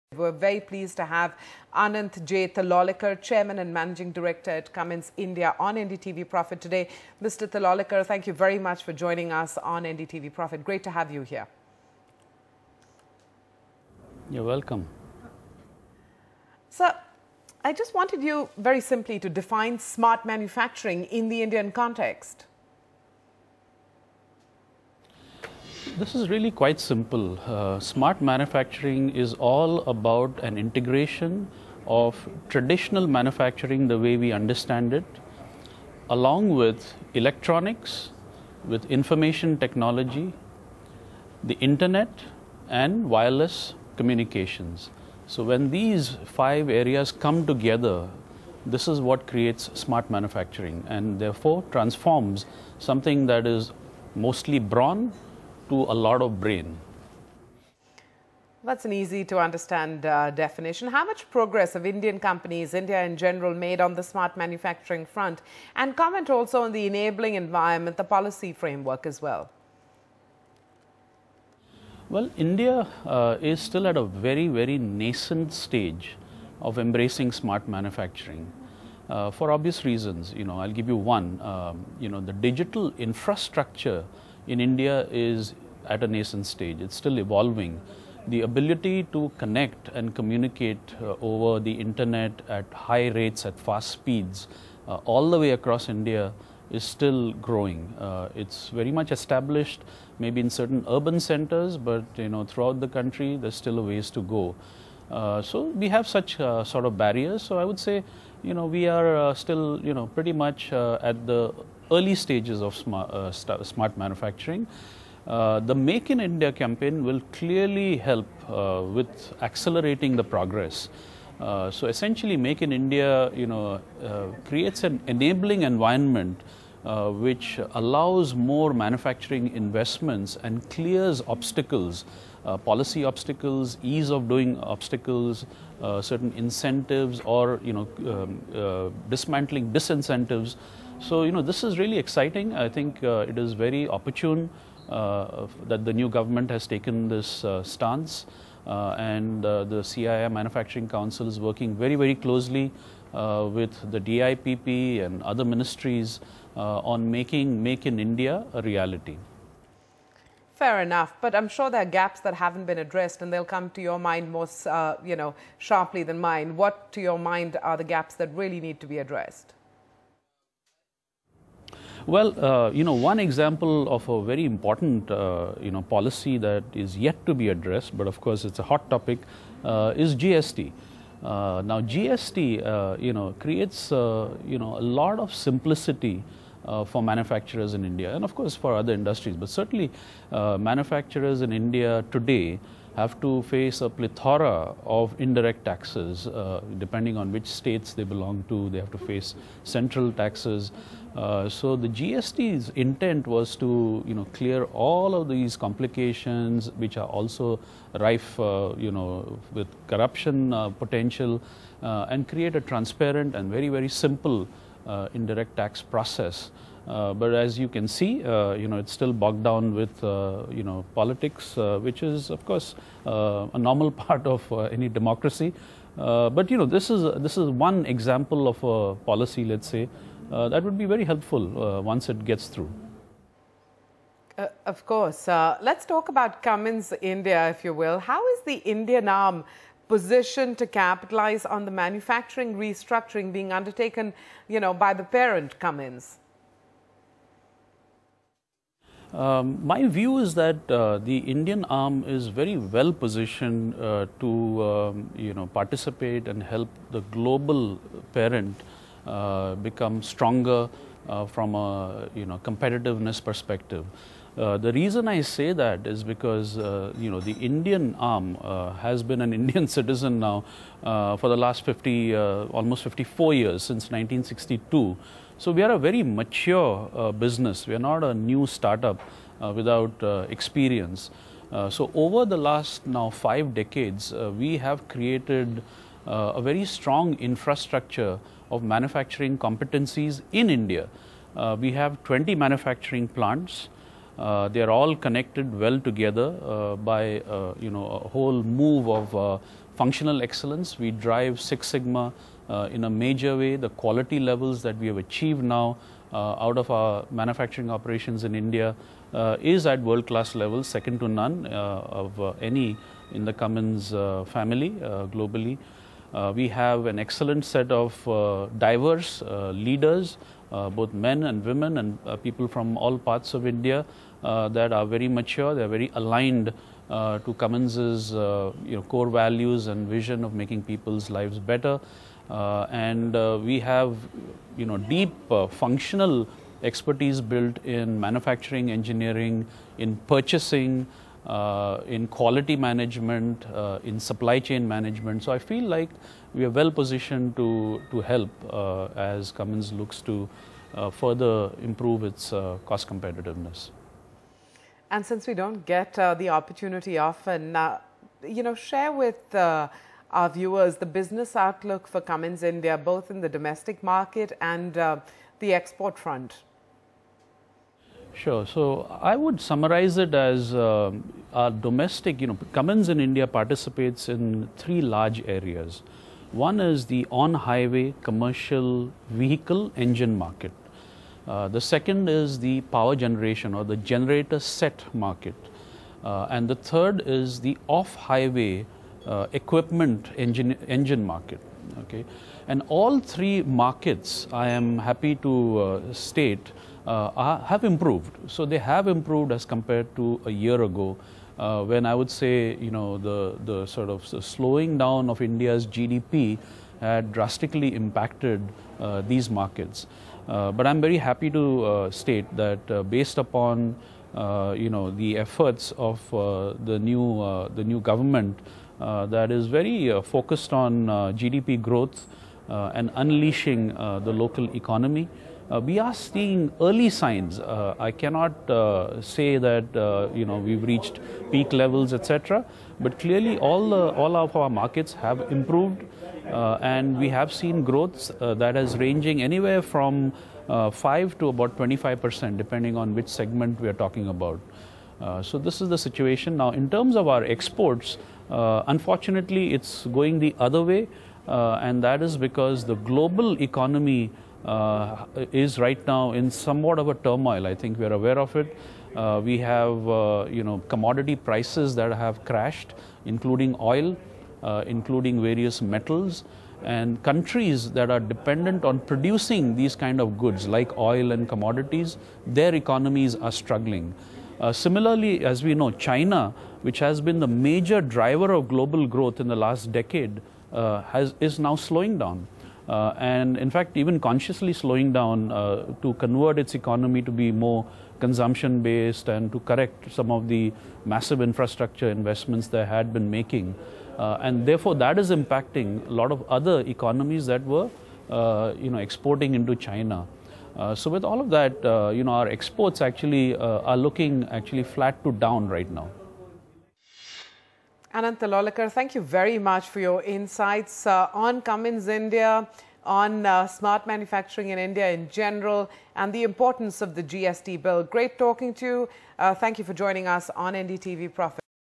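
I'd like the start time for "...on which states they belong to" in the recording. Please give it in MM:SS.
03:17.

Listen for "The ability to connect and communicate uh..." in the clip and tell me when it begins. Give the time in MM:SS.
01:28.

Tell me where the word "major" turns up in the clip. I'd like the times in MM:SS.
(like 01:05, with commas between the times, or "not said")
05:02, 07:57.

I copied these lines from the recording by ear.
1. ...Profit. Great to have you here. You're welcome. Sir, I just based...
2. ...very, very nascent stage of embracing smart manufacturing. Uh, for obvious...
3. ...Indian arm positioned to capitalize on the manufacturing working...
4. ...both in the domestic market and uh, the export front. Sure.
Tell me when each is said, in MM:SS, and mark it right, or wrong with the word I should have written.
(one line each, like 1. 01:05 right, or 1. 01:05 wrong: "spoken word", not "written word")
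1. 00:10 wrong: "wanted", not "based"
2. 01:14 right
3. 03:58 wrong: "restructuring", not "working"
4. 06:02 right.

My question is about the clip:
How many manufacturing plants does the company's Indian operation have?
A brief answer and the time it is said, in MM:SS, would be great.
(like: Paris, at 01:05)
20, at 04:52.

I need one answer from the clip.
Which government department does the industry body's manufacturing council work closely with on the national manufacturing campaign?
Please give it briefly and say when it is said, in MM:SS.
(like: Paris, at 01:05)
DIPP, at 02:33.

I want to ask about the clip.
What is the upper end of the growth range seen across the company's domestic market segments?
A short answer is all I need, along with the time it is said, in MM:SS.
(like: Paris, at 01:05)
25%, at 07:21.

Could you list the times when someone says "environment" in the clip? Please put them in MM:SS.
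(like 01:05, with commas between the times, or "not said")
01:07, 02:05.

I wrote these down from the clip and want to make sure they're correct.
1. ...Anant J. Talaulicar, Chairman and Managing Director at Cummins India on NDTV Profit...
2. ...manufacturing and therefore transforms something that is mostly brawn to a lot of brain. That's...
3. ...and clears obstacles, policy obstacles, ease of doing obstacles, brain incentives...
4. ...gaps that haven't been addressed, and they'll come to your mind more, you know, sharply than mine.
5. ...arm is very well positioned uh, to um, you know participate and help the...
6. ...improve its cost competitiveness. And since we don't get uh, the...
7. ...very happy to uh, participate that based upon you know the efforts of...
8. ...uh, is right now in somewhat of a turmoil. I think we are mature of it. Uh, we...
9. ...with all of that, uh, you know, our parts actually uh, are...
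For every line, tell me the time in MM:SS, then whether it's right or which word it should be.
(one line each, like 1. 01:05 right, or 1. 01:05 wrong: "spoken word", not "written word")
1. 00:01 right
2. 00:50 right
3. 02:10 wrong: "certain", not "brain"
4. 02:41 right
5. 04:11 right
6. 05:51 right
7. 06:50 wrong: "state", not "participate"
8. 07:34 wrong: "aware", not "mature"
9. 08:20 wrong: "exports", not "parts".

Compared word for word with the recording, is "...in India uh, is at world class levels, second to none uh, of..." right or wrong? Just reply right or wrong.
right.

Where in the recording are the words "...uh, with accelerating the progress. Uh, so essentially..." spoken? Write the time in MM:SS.
01:58.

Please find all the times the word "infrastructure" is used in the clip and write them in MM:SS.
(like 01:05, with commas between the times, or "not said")
01:22, 04:47, 08:11.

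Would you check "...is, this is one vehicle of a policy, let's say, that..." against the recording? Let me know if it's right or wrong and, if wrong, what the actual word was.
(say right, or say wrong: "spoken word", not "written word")
wrong: "example", not "vehicle".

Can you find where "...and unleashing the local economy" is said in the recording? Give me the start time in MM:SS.
07:02.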